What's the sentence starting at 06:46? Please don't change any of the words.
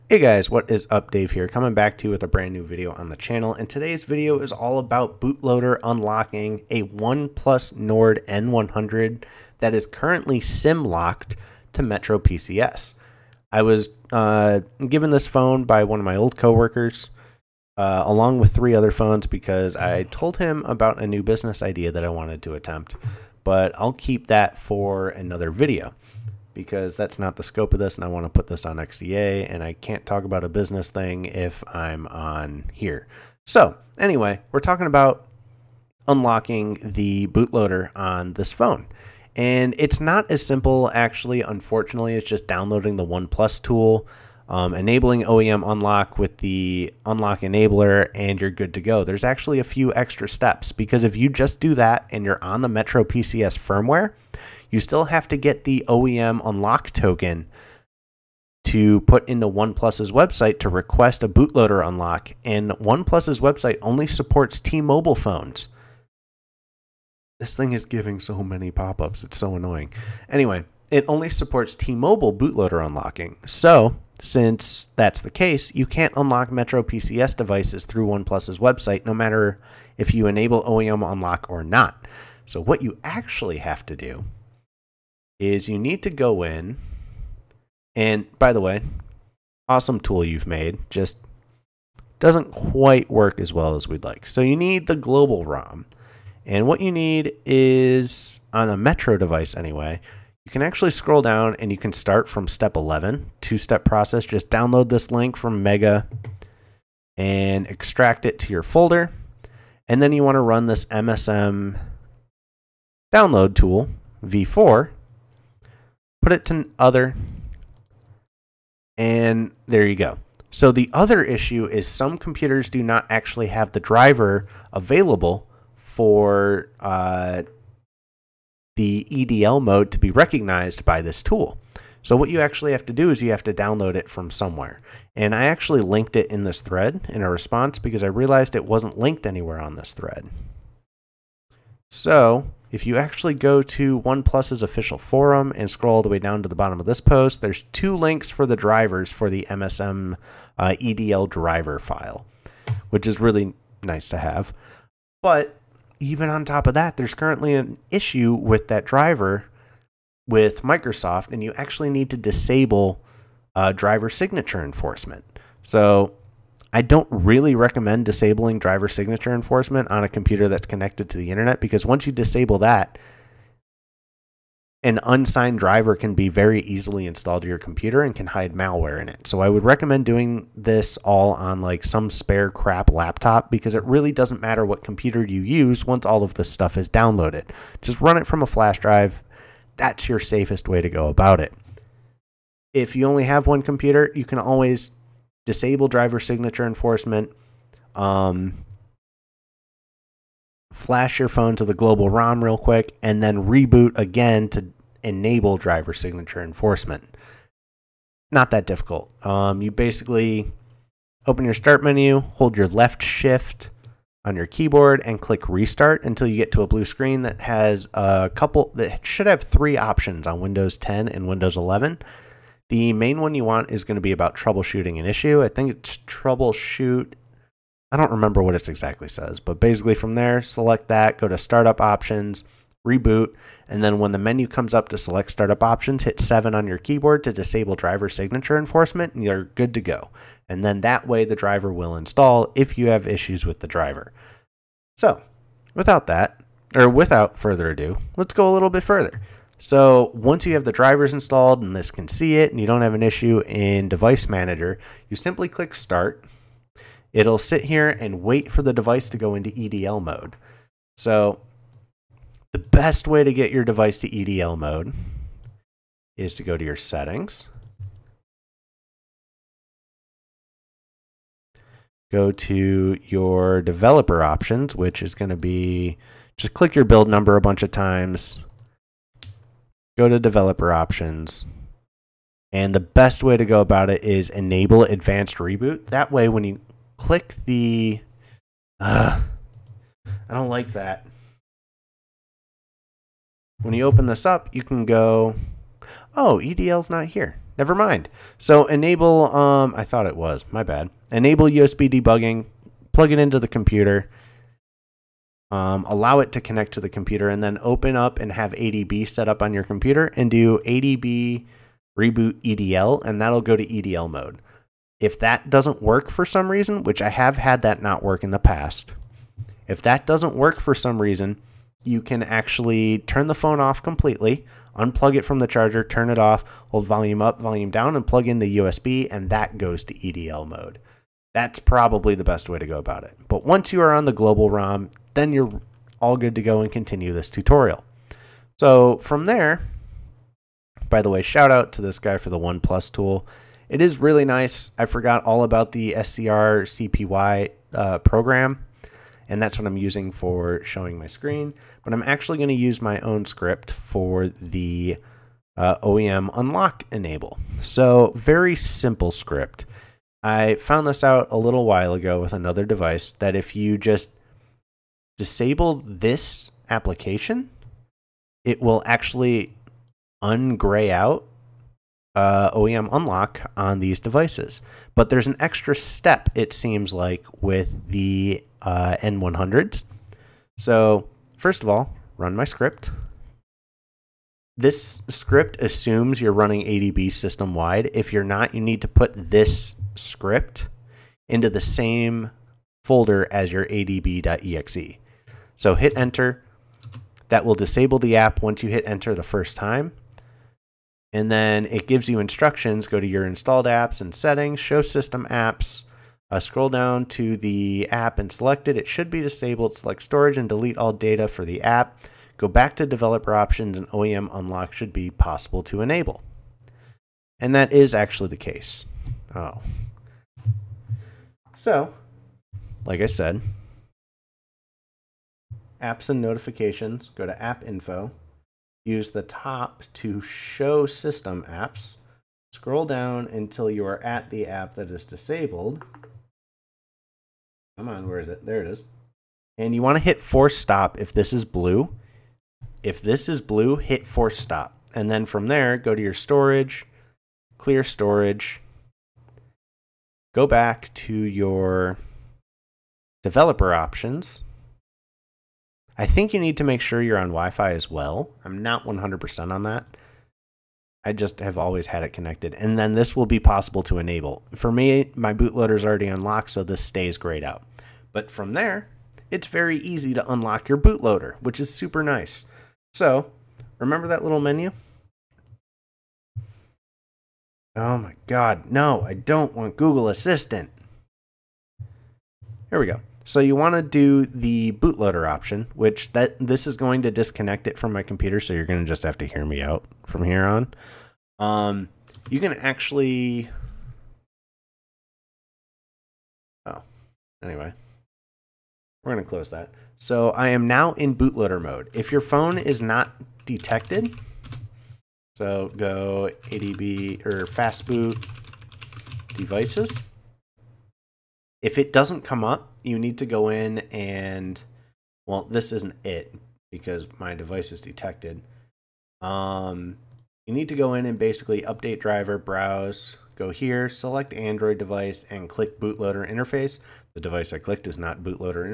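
Uh, scroll down to the app and select it.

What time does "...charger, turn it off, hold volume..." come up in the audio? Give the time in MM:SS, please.
05:25.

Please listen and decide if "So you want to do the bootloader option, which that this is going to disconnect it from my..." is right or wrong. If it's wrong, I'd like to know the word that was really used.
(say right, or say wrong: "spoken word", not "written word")
right.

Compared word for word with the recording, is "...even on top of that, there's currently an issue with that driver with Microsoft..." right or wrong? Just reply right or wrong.
right.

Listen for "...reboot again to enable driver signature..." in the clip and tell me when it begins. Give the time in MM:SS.
03:23.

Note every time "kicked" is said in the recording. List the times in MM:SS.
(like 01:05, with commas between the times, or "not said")
not said.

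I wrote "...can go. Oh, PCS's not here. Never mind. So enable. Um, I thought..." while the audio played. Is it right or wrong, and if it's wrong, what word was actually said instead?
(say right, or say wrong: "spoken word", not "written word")
wrong: "EDL", not "PCS".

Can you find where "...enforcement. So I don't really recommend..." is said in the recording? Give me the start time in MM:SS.
02:44.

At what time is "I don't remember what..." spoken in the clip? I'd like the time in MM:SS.
03:47.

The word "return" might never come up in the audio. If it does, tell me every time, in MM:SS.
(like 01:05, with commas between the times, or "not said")
not said.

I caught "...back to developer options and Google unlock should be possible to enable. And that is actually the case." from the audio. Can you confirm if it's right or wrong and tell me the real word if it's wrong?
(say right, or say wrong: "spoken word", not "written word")
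wrong: "OEM", not "Google".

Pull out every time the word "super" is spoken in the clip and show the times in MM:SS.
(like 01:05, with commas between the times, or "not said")
07:51.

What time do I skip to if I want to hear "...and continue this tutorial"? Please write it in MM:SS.
05:36.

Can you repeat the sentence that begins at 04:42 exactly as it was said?
And the best way to go about it is enable advanced reboot.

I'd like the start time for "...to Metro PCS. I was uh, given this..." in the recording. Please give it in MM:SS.
00:11.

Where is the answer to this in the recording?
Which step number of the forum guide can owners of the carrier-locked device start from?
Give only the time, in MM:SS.
01:42.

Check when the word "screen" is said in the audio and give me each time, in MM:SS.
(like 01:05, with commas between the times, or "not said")
03:36, 05:51.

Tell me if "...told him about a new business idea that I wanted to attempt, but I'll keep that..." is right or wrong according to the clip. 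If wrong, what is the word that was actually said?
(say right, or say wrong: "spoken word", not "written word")
right.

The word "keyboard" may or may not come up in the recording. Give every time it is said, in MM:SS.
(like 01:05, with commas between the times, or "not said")
03:34, 03:56.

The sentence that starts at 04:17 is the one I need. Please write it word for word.
It'll sit here and wait for the device to go into EDL mode.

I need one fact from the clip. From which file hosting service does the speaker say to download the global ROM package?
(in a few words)
Mega.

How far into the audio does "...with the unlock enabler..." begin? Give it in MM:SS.
00:46.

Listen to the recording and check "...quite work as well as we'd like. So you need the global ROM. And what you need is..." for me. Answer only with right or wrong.
right.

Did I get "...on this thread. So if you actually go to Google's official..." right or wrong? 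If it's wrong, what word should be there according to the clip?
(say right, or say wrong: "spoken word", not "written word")
wrong: "OnePlus", not "Google".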